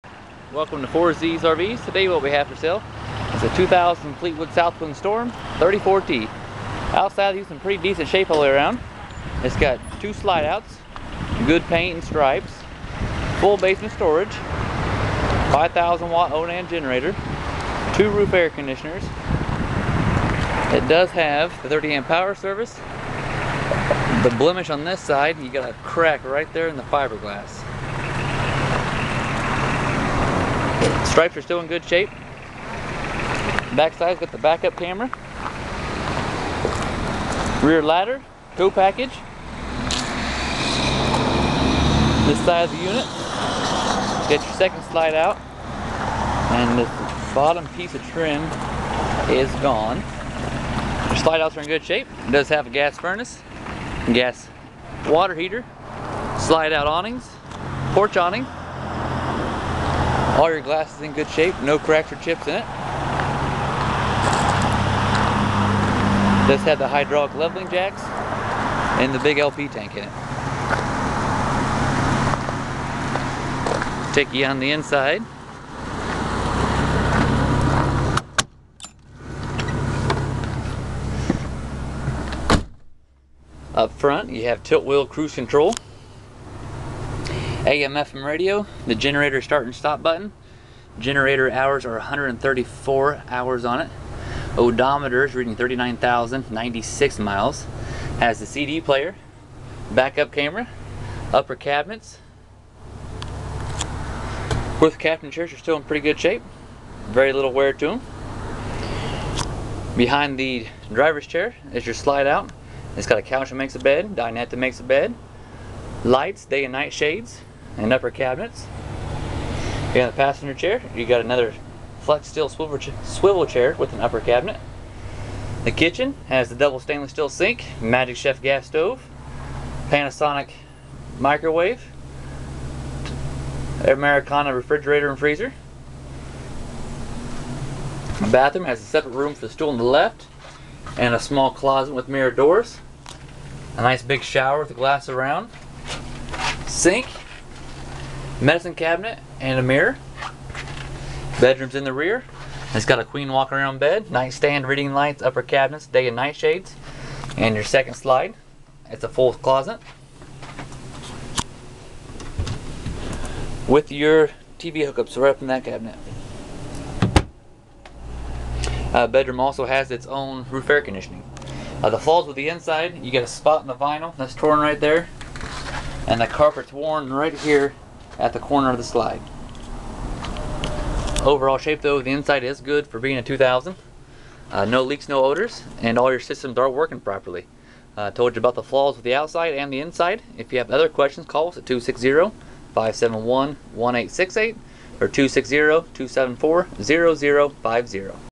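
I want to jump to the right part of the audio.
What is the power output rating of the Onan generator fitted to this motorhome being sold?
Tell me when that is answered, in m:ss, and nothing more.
0:15.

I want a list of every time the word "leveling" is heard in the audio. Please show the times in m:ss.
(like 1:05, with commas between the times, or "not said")
1:07.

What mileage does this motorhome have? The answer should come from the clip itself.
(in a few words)
39,096.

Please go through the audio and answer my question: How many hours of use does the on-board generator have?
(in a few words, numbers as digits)
134.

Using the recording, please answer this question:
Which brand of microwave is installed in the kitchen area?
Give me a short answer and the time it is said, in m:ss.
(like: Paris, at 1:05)
Panasonic, at 2:09.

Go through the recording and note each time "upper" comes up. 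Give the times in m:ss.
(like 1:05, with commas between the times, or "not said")
1:41, 1:57, 2:04, 2:35.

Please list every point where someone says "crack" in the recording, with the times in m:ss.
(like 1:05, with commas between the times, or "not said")
0:25, 1:01.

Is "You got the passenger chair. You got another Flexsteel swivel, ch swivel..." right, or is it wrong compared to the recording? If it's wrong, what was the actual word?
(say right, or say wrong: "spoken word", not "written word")
right.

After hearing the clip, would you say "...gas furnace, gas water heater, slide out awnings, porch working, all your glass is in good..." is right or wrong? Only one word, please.
wrong.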